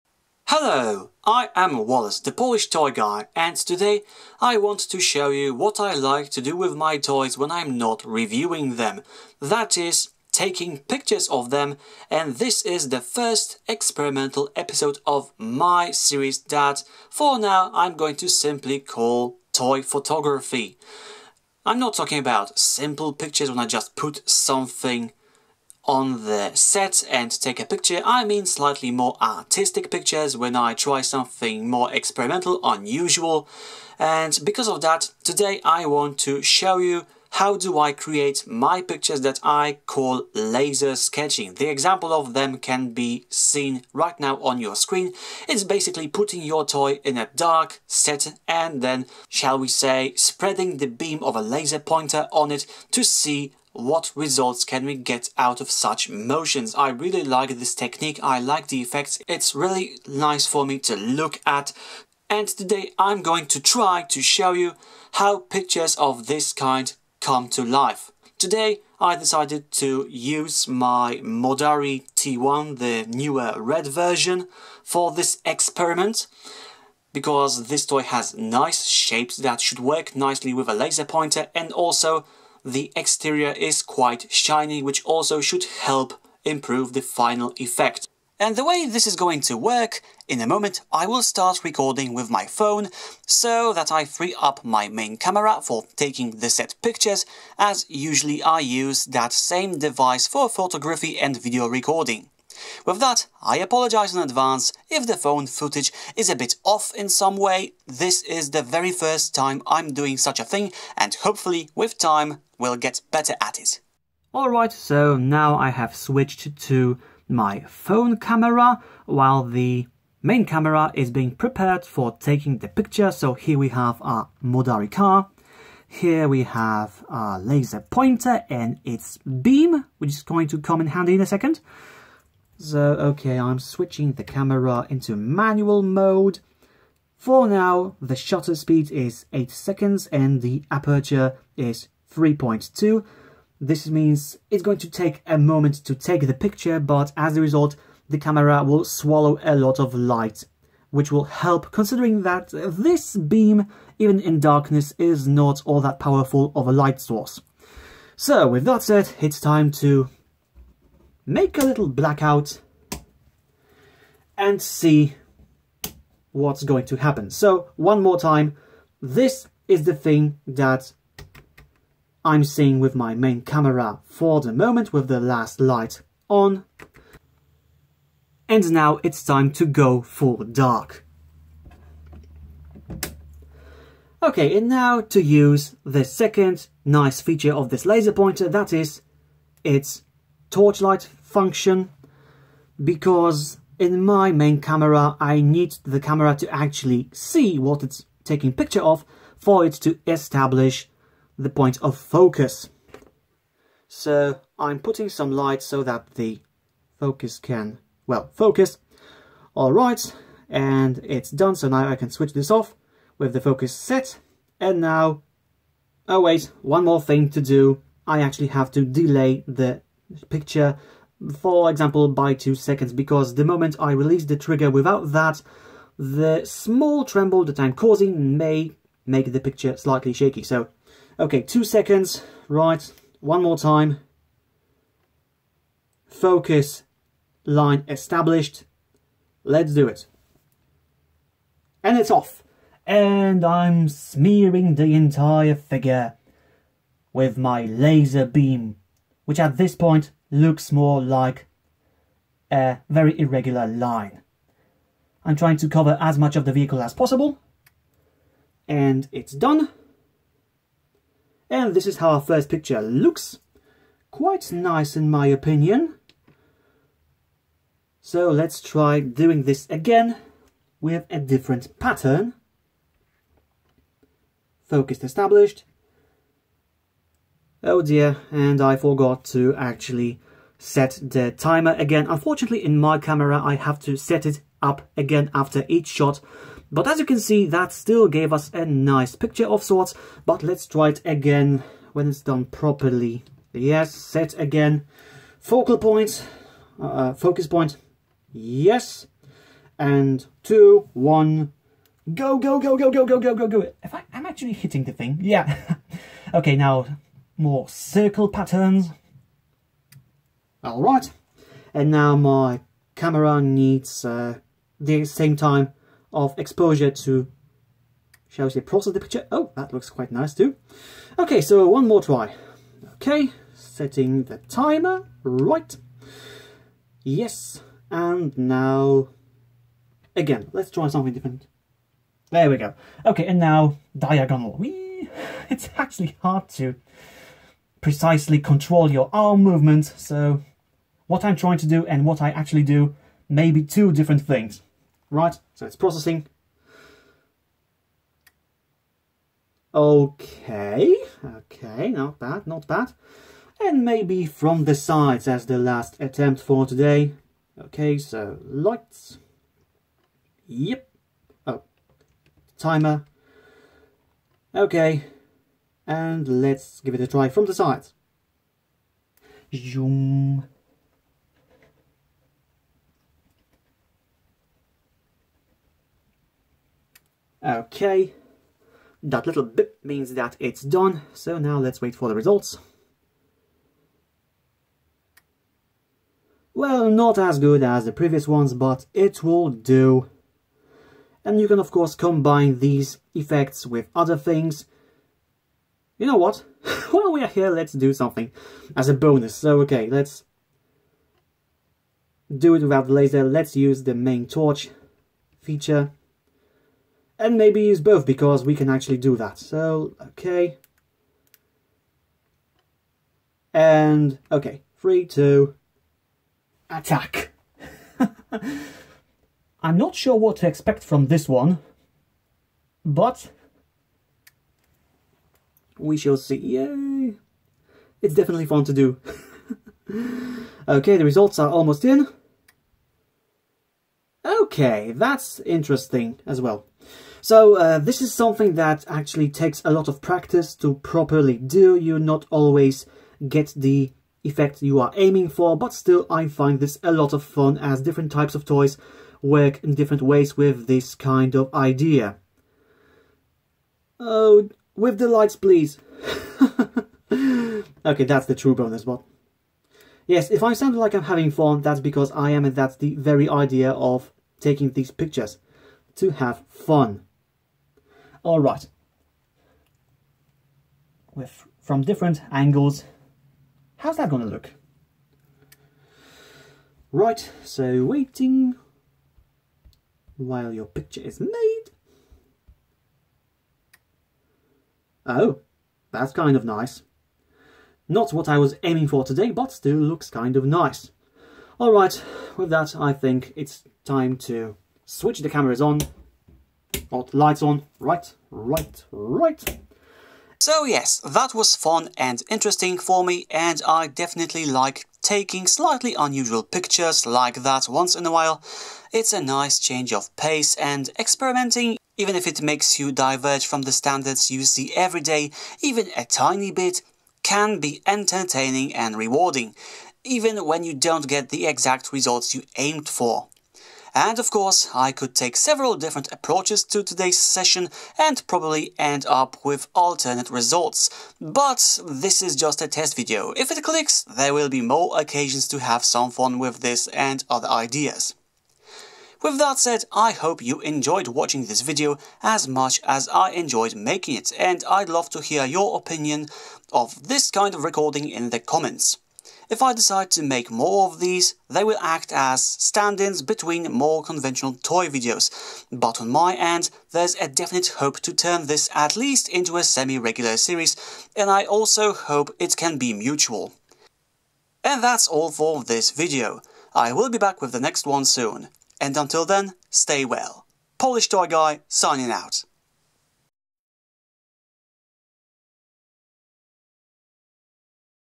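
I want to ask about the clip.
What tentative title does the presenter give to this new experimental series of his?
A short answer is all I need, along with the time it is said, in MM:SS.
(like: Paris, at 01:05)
Toy Photography, at 00:19.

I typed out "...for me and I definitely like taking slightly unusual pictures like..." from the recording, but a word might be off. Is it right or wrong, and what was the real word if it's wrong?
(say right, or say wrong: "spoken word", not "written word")
right.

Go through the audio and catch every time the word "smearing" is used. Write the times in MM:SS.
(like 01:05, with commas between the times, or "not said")
04:03.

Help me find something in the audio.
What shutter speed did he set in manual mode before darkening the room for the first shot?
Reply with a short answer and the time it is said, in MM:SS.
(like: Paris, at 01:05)
8 seconds, at 02:19.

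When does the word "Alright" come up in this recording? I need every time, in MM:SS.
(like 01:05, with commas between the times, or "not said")
01:54, 08:11.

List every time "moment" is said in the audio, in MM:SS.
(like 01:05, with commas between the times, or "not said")
01:30, 02:25, 02:54, 03:43.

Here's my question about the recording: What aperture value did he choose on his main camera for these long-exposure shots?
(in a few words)
3.2.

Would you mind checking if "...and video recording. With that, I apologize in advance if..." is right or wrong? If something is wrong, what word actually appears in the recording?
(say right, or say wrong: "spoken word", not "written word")
right.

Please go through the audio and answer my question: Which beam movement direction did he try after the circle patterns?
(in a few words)
Diagonal.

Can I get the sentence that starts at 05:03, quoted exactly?
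If I, I'm actually hitting the thing, yeah.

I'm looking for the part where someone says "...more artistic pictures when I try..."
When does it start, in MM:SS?
00:28.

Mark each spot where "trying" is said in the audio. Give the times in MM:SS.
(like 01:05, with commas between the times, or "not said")
04:15, 05:41.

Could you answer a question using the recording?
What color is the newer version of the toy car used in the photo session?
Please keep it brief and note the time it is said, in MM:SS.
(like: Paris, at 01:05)
Red, at 01:13.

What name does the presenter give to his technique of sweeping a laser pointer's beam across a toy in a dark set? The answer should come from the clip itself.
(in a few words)
Laser sketching.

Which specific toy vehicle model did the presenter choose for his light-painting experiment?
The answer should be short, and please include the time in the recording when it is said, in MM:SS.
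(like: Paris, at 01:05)
Modarri T1, at 01:11.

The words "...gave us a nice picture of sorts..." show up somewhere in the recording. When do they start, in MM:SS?
04:48.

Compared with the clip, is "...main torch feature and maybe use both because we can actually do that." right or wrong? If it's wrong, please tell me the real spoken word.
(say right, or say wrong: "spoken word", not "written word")
right.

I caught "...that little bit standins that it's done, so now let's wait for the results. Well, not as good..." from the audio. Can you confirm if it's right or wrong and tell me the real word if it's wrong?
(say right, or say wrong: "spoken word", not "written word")
wrong: "means", not "standins".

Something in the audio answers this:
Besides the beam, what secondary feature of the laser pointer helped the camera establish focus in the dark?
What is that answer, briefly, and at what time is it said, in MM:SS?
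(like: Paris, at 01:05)
Torchlight function, at 03:10.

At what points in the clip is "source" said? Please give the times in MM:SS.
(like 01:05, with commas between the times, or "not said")
02:36.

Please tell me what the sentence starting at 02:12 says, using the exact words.
So, okay, I'm switching the camera into manual mode.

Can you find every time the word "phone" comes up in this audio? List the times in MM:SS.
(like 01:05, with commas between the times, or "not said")
01:32, 01:45, 01:57.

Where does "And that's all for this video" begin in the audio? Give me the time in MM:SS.
09:24.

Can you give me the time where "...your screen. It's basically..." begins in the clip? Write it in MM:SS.
00:44.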